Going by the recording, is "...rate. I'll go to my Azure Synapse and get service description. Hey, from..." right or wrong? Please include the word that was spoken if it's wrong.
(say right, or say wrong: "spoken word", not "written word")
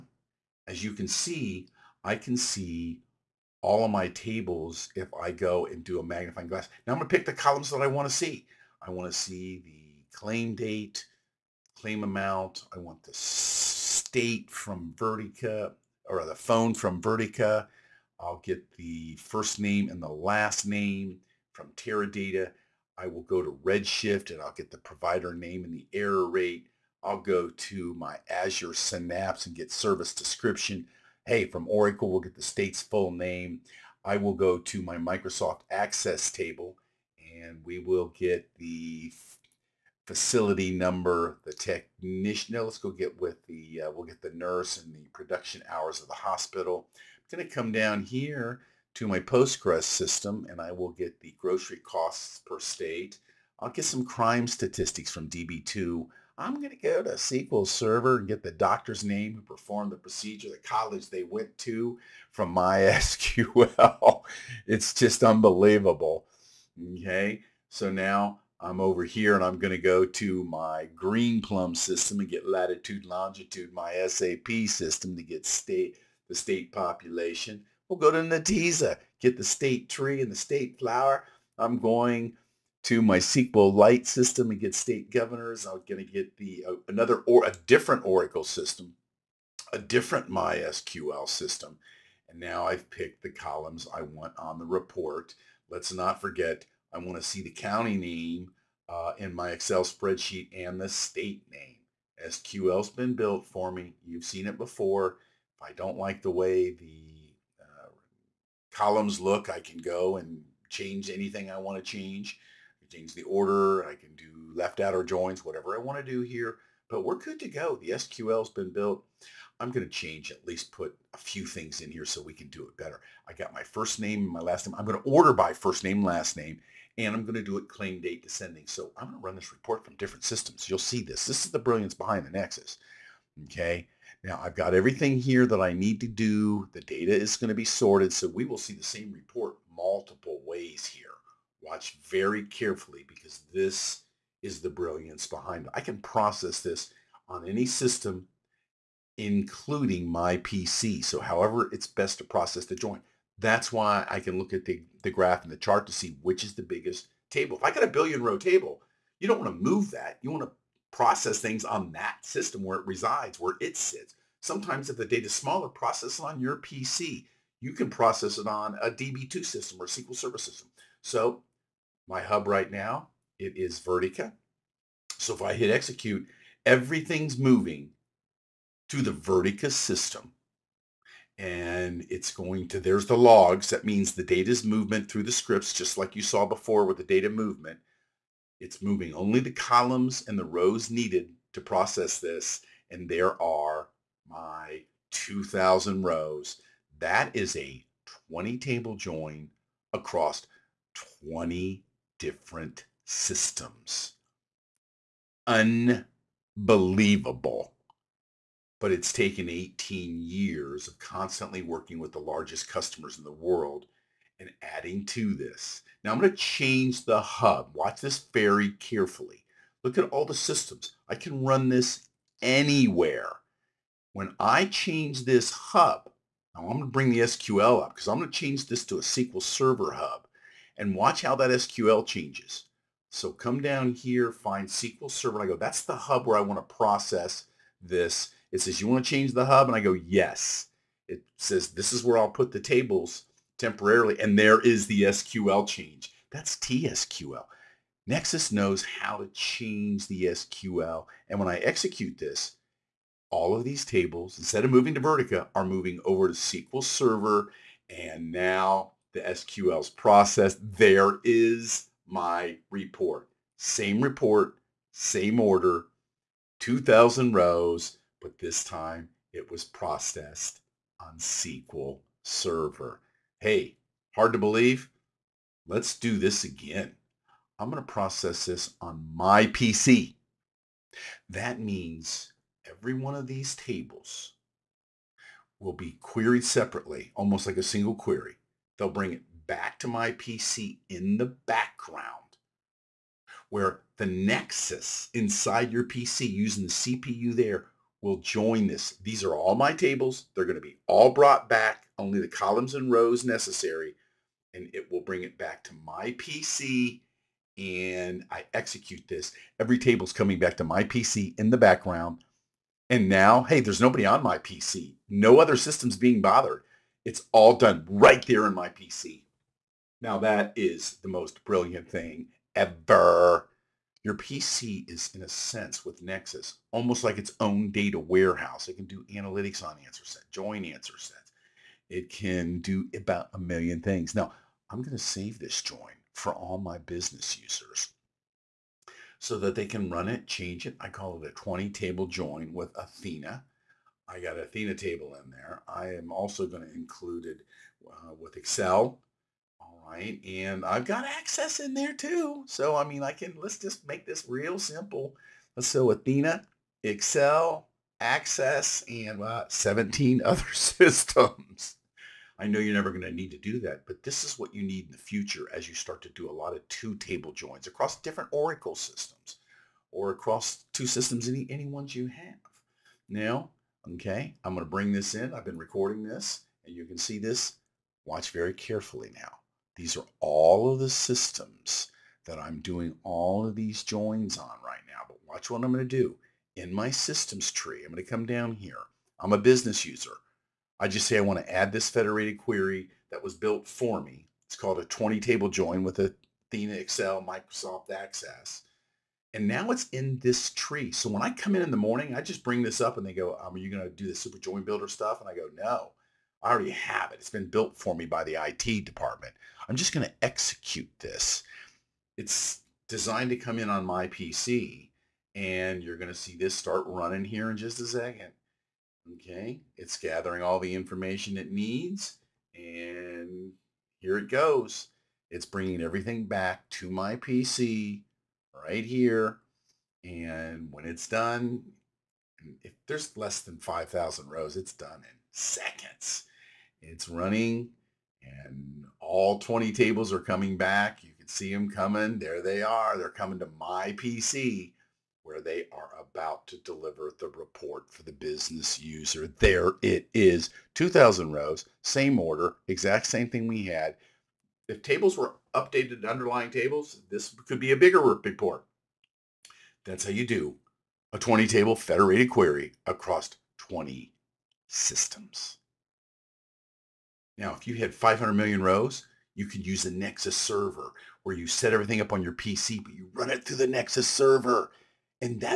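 right.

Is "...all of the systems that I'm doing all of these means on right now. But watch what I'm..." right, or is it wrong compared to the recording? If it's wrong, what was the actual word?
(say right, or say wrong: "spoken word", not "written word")
wrong: "joins", not "means".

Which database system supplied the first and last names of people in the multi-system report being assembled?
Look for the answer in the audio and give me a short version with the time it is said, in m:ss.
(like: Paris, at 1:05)
Teradata, at 0:21.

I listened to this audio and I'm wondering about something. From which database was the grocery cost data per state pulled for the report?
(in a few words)
Postgres.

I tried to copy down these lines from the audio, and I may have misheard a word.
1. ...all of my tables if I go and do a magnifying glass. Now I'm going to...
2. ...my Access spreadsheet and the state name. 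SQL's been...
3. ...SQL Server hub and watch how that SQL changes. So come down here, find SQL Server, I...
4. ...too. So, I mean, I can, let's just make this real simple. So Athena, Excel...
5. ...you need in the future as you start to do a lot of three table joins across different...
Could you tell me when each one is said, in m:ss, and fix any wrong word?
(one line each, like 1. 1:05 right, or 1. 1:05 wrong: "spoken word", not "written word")
1. 0:03 right
2. 1:39 wrong: "Excel", not "Access"
3. 3:49 right
4. 5:51 right
5. 6:04 wrong: "two", not "three".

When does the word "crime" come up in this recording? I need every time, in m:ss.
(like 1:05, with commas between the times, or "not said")
0:54.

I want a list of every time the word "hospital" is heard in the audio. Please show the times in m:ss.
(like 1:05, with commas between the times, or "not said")
0:46.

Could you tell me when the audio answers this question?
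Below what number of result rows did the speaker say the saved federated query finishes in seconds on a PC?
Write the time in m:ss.
7:13.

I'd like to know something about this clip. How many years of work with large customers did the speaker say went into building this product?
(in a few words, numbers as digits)
18 years.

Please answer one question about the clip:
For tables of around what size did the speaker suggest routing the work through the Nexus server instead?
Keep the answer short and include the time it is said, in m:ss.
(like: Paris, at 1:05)
500 million rows, at 7:47.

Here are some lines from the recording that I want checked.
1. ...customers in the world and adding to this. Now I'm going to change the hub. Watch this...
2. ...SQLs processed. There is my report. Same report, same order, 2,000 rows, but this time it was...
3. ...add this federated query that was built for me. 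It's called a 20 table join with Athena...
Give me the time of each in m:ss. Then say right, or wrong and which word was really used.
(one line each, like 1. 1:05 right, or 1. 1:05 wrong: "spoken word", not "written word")
1. 3:32 right
2. 4:19 right
3. 6:31 right.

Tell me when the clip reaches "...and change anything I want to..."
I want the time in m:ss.
1:50.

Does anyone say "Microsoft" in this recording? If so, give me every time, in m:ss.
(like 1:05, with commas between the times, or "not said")
0:34, 6:37.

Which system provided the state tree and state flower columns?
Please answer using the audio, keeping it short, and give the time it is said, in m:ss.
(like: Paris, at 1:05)
Netezza, at 1:18.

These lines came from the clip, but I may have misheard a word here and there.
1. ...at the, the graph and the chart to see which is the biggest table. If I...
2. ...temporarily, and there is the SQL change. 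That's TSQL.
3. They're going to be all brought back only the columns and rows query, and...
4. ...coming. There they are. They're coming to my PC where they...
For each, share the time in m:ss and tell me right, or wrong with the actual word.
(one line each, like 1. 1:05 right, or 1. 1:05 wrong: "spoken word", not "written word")
1. 2:34 right
2. 4:03 right
3. 5:00 wrong: "necessary", not "query"
4. 7:21 right.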